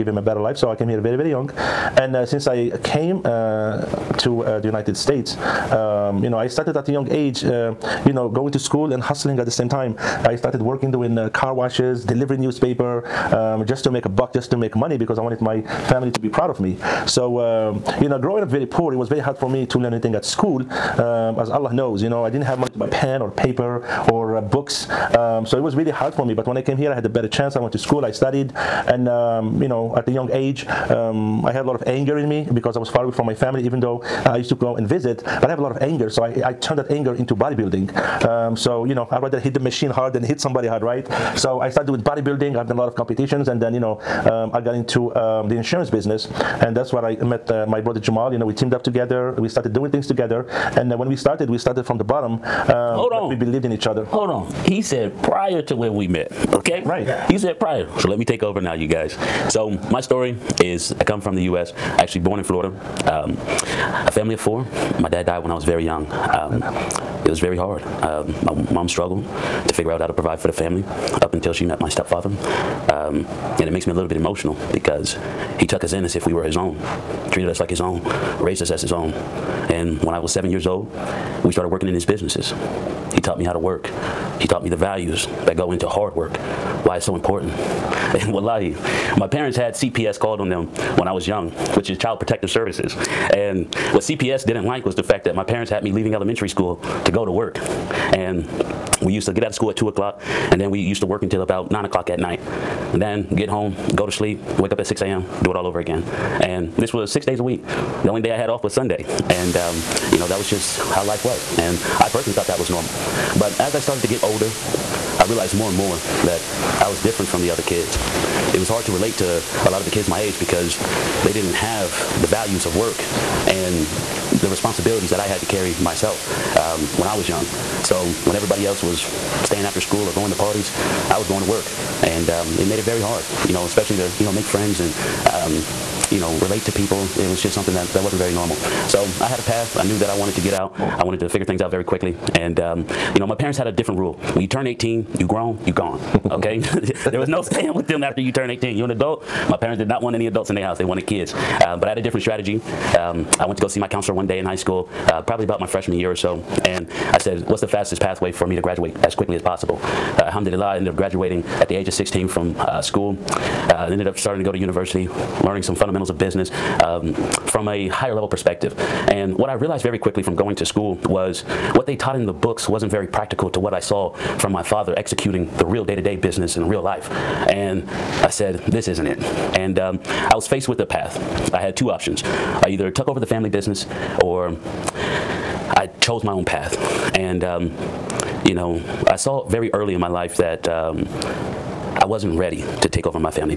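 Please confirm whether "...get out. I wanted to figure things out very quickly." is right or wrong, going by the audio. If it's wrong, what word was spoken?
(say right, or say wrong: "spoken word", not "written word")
right.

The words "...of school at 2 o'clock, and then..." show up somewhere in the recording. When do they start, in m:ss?
1:39.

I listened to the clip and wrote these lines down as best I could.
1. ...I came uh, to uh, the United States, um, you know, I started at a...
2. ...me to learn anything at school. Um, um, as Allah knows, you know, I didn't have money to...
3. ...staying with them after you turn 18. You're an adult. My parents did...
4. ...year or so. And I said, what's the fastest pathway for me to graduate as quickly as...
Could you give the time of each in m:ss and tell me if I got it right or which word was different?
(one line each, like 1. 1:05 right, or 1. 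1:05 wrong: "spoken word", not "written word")
1. 0:02 right
2. 0:19 right
3. 2:27 right
4. 2:35 right.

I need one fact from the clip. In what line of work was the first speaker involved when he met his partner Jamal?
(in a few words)
Insurance business.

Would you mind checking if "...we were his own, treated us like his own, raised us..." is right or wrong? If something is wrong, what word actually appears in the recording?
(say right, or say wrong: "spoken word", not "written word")
right.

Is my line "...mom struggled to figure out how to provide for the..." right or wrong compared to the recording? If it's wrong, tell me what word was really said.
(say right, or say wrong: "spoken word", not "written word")
right.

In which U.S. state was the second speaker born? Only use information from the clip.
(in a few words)
Florida.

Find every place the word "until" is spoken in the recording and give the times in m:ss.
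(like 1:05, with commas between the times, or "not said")
1:11, 1:41.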